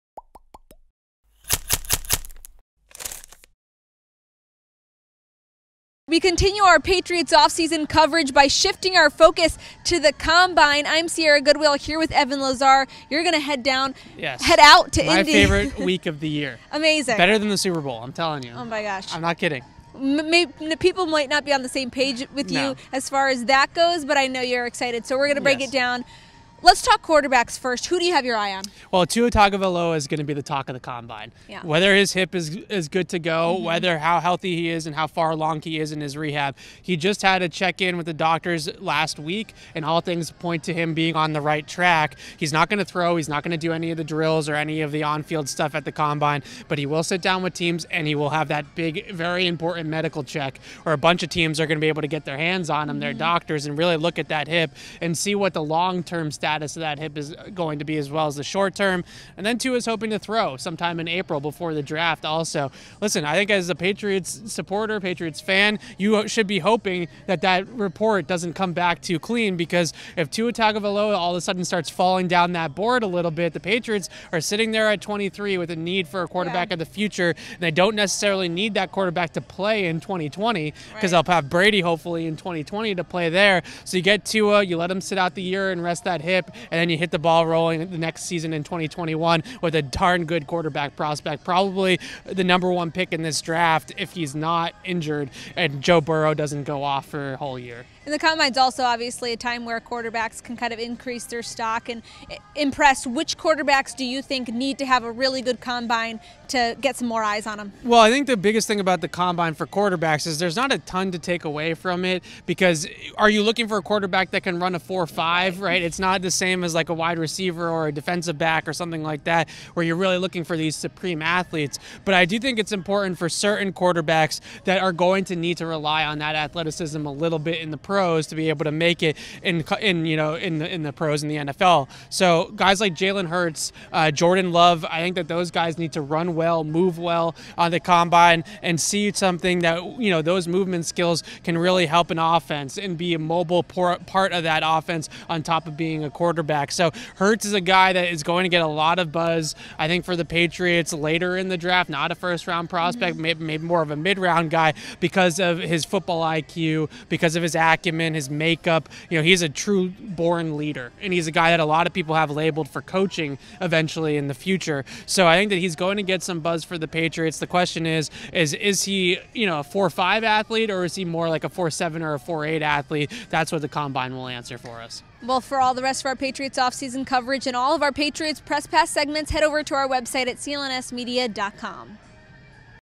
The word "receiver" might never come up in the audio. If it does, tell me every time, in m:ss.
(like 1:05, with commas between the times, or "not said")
1:57.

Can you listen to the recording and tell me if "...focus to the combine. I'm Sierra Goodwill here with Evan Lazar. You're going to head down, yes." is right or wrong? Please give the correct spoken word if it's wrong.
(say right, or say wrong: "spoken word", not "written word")
right.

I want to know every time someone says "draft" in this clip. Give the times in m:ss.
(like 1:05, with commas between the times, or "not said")
1:01, 1:33, 2:31.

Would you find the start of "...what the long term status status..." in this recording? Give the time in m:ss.
0:55.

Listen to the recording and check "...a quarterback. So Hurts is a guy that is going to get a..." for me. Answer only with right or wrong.
right.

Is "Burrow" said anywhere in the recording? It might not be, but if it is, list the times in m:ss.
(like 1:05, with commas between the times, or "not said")
1:36.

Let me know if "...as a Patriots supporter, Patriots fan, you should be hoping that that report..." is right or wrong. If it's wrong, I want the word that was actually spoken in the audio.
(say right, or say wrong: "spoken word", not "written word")
right.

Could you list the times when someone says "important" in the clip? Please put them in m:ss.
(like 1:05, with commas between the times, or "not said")
0:49, 2:02.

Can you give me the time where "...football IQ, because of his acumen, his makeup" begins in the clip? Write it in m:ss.
2:35.